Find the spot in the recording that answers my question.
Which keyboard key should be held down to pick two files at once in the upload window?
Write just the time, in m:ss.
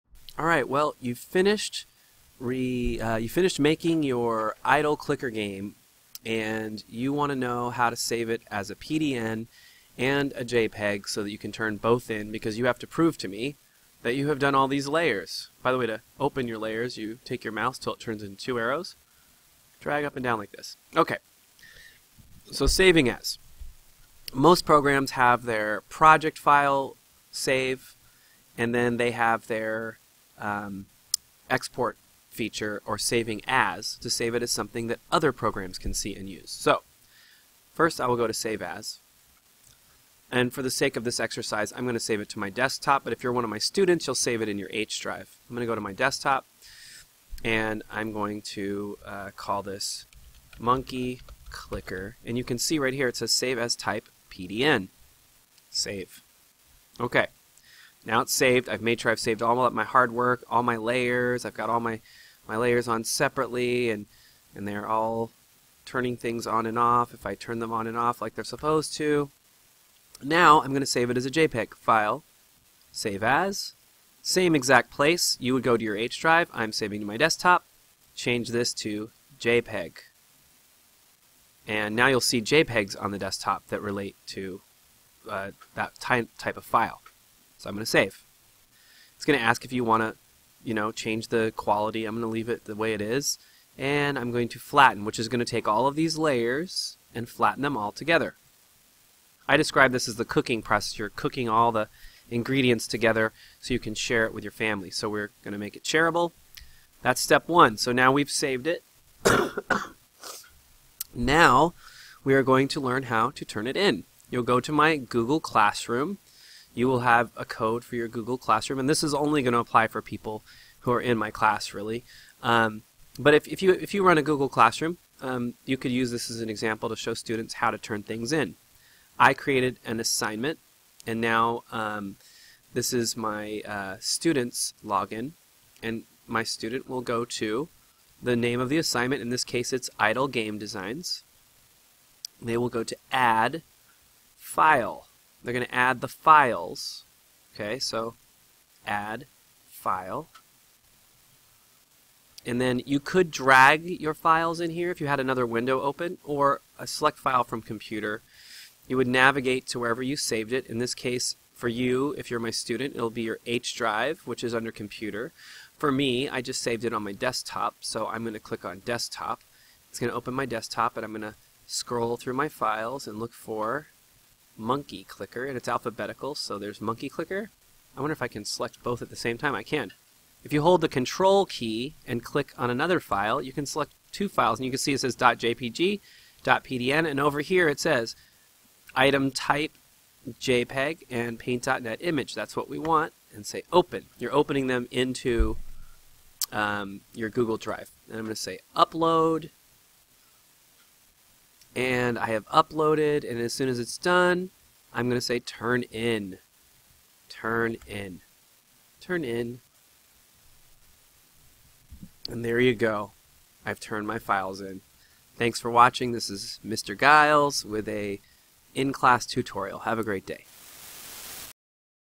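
3:00.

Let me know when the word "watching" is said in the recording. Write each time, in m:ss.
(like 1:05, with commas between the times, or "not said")
3:35.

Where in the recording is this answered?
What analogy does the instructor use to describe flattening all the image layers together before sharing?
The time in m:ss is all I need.
1:40.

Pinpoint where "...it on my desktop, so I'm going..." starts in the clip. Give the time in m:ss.
2:46.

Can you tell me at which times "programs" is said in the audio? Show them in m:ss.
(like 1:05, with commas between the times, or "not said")
0:24, 0:35.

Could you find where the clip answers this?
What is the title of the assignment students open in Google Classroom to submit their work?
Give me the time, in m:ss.
2:19.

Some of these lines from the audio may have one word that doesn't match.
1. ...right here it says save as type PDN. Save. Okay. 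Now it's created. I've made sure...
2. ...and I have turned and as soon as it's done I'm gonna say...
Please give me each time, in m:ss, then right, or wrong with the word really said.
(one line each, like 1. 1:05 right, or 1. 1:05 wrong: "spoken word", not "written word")
1. 0:52 wrong: "saved", not "created"
2. 3:21 wrong: "uploaded", not "turned".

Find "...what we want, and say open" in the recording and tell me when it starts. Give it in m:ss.
3:12.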